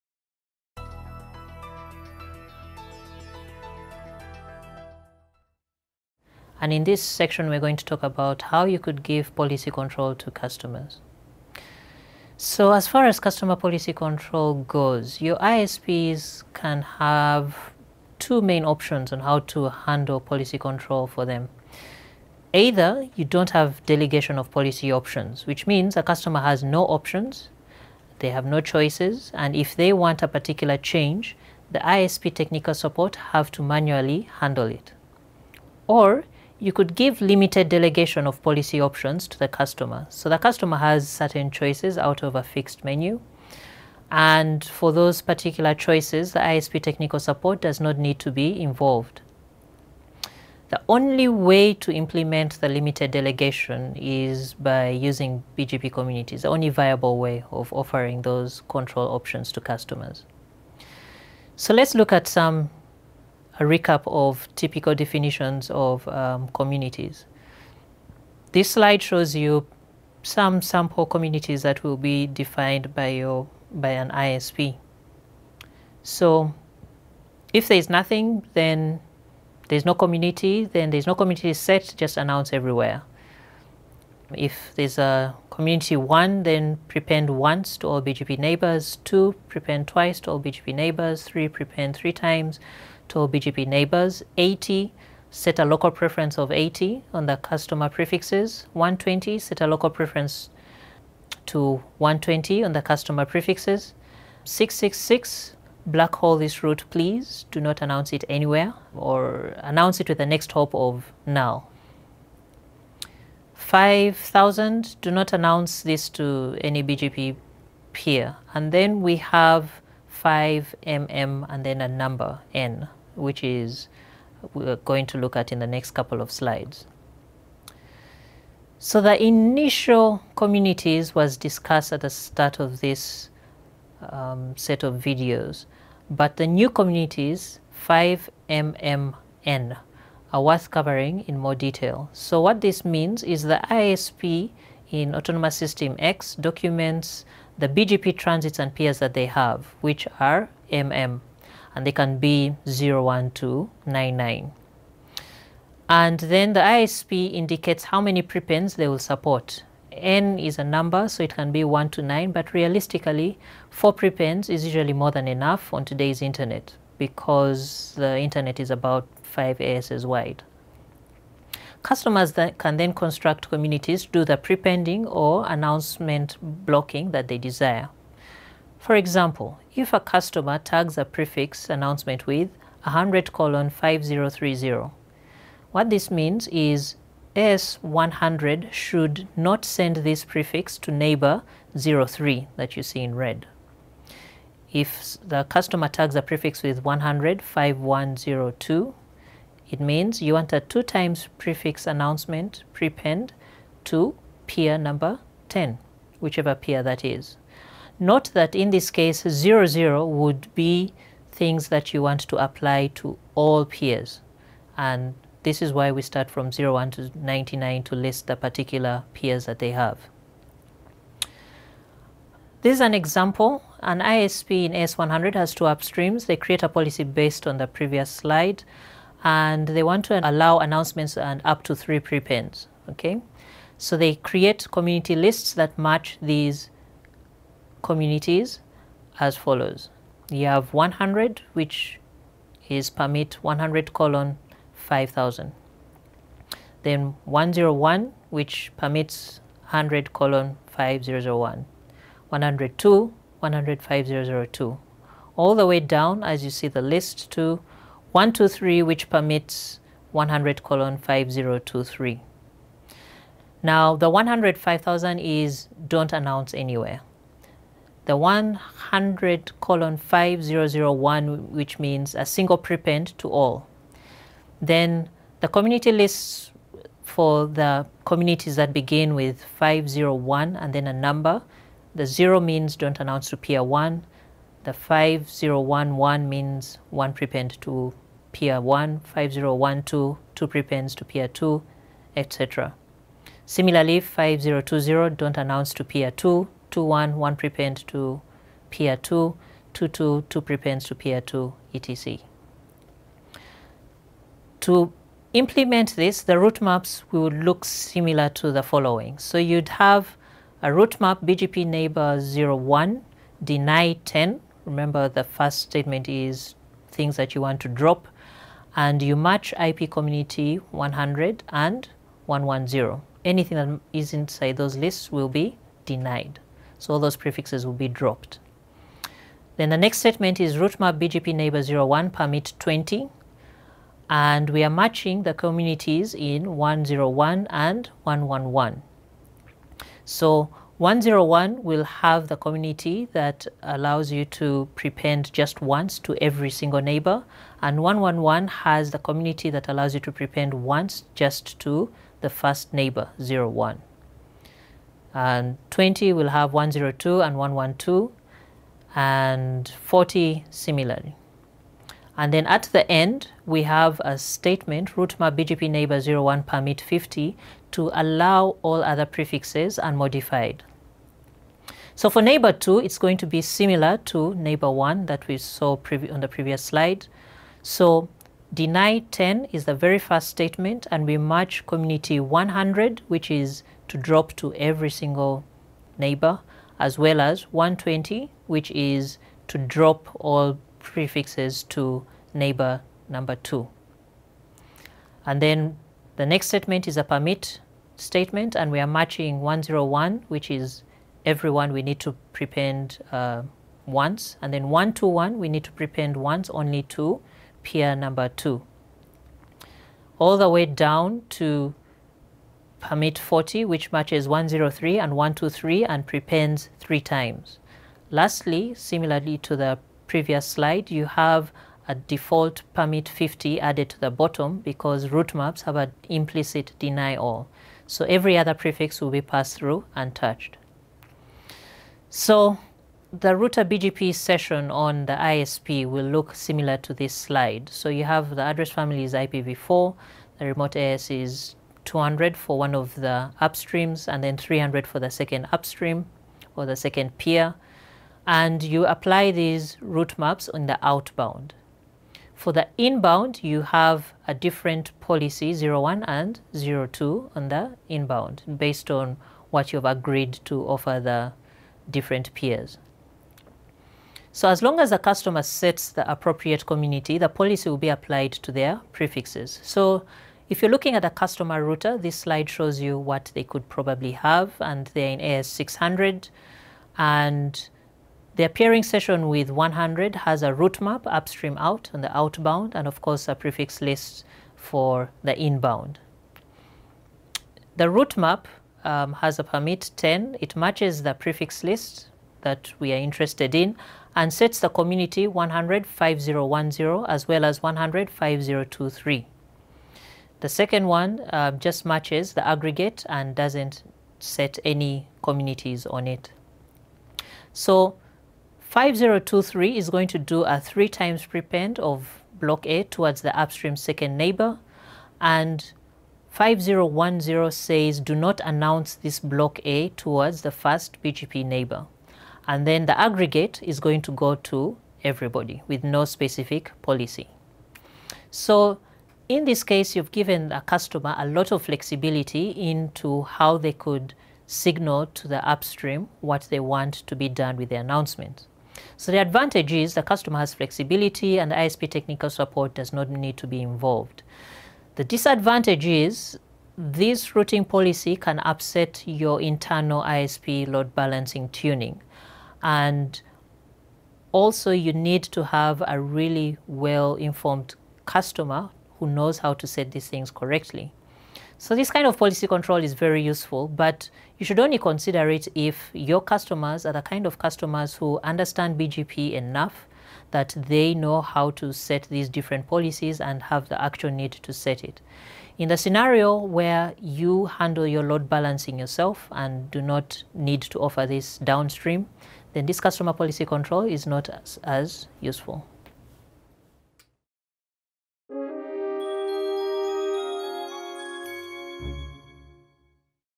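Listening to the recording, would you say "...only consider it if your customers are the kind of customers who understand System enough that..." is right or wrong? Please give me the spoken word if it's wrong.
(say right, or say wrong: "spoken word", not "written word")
wrong: "BGP", not "System".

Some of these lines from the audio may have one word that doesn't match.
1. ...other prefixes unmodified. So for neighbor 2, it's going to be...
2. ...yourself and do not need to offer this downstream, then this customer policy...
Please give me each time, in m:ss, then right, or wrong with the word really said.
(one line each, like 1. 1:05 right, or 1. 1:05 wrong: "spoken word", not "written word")
1. 6:08 right
2. 9:38 right.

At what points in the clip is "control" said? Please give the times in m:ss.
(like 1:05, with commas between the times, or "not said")
0:09, 0:13, 0:20, 0:58, 9:22, 9:43.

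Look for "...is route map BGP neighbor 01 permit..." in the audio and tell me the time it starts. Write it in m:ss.
5:30.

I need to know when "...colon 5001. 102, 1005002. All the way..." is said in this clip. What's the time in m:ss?
4:10.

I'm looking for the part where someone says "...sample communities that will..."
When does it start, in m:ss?
1:10.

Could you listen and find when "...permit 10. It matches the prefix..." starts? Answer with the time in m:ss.
8:09.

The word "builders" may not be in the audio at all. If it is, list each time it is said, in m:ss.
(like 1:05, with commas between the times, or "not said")
not said.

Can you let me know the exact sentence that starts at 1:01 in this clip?
So let's look at some a recap of typical definitions of um, communities.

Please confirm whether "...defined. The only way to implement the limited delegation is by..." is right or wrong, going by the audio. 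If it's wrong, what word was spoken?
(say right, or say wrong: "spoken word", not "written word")
wrong: "involved", not "defined".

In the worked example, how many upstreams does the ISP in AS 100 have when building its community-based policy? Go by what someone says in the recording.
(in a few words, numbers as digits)
2.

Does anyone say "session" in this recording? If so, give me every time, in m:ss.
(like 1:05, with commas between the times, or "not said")
7:14, 7:58.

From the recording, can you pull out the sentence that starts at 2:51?
Customers th can then construct communities, do the prepending or announcement blocking that they desire.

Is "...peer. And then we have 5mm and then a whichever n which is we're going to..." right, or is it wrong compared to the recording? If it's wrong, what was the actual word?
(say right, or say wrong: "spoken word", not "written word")
wrong: "number", not "whichever".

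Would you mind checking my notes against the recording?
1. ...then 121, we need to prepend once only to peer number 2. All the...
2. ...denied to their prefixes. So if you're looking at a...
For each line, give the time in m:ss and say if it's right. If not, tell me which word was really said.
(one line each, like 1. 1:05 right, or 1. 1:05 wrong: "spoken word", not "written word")
1. 6:44 right
2. 7:47 wrong: "applied", not "denied".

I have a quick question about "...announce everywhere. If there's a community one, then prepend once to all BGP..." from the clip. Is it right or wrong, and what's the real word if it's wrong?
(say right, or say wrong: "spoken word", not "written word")
right.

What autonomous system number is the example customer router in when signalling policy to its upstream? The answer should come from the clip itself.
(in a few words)
AS600.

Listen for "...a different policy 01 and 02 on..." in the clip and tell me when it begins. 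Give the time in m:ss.
7:34.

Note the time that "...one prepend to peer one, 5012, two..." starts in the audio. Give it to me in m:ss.
4:46.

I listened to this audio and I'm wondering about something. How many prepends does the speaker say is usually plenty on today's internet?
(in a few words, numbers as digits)
4.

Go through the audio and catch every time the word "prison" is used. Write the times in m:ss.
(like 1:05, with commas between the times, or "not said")
not said.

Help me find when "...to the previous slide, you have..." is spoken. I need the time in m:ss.
6:59.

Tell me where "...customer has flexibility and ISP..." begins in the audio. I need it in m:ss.
9:00.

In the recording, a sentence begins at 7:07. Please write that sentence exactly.
So every other prefix will be passed through untouched.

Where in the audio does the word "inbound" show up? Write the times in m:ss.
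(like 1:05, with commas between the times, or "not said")
7:32, 7:37, 8:05.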